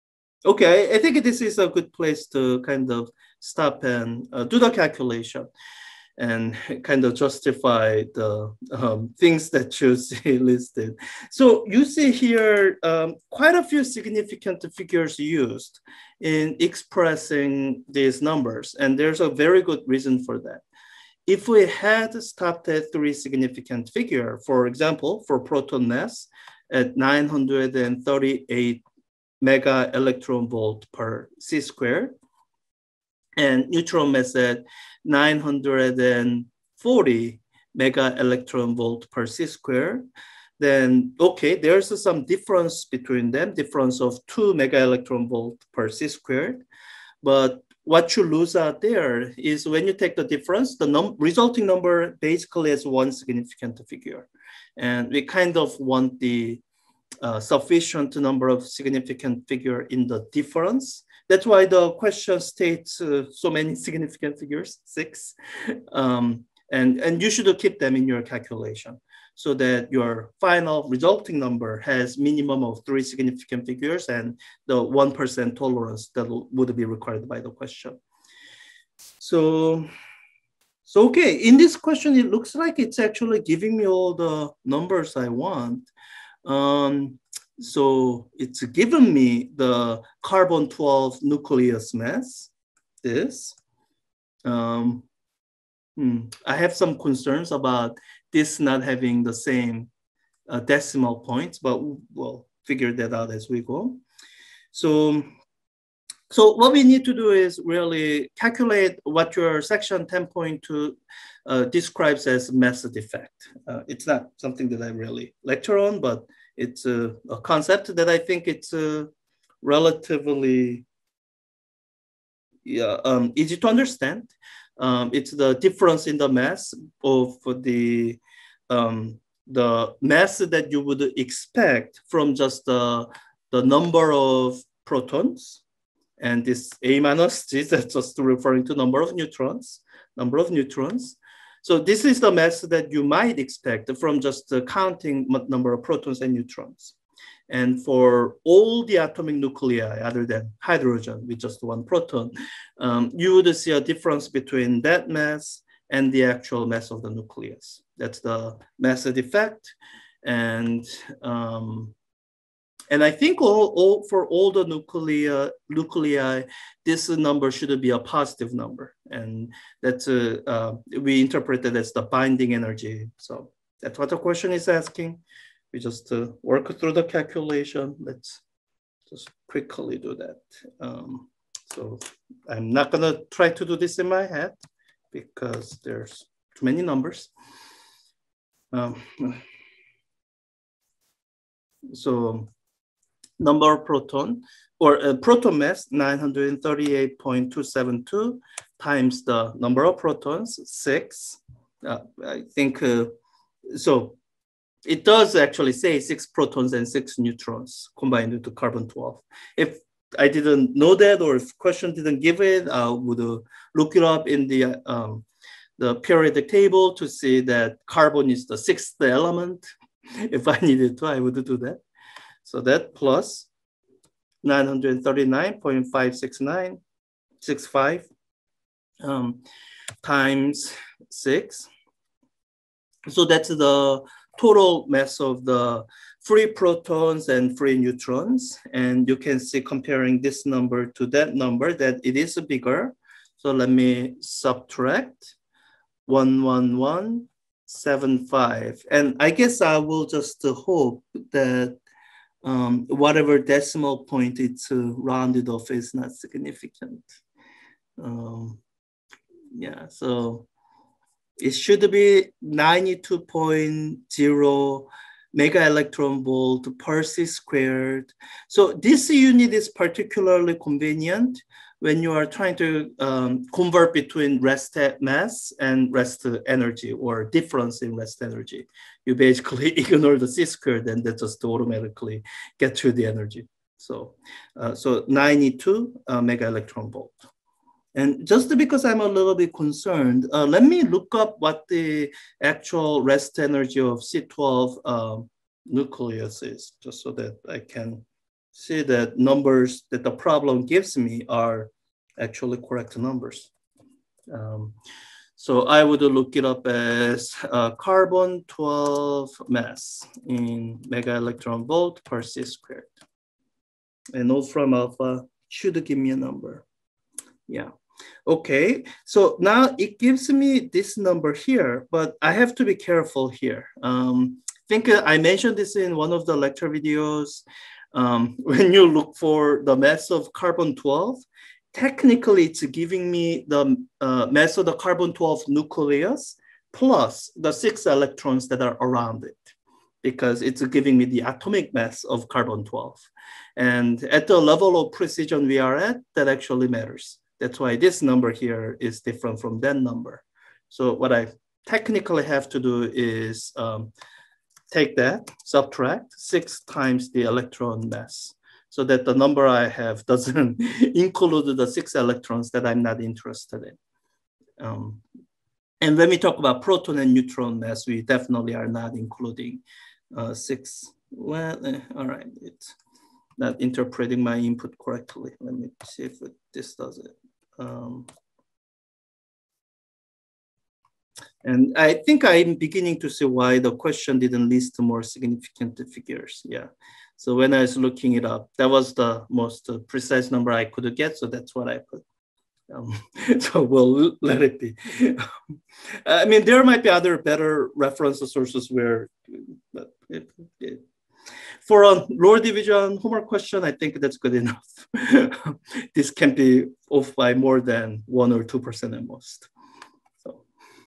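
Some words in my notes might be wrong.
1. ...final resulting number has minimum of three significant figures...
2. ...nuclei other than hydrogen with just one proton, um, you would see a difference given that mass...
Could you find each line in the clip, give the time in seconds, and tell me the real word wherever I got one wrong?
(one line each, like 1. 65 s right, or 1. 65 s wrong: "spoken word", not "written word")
1. 70 s right
2. 149 s wrong: "between", not "given".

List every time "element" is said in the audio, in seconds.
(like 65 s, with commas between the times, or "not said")
219 s.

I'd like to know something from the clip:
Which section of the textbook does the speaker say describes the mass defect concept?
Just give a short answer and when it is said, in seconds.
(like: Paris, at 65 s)
Section 10.2, at 109 s.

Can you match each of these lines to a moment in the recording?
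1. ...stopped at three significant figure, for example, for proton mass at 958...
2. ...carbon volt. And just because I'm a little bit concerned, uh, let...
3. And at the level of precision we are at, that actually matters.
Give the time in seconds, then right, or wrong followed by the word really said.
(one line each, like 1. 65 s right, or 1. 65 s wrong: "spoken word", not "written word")
1. 22 s wrong: "938", not "958"
2. 286 s wrong: "electron", not "carbon"
3. 343 s right.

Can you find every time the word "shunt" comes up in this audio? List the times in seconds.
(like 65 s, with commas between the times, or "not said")
not said.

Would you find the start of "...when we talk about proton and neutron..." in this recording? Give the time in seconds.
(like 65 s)
365 s.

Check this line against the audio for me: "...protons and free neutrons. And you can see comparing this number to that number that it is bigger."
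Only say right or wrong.
right.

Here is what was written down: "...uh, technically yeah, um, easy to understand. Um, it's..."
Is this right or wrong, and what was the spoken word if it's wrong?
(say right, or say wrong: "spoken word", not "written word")
wrong: "relatively", not "technically".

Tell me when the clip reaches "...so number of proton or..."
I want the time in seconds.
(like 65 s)
191 s.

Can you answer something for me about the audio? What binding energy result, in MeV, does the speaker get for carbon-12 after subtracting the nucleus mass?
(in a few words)
92.0 MeV.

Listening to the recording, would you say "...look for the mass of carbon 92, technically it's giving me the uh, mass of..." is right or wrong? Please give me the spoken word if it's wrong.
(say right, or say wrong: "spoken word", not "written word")
wrong: "12", not "92".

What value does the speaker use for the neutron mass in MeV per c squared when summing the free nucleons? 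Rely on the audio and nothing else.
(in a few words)
939.56965.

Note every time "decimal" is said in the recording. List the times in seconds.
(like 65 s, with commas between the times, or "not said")
100 s, 253 s.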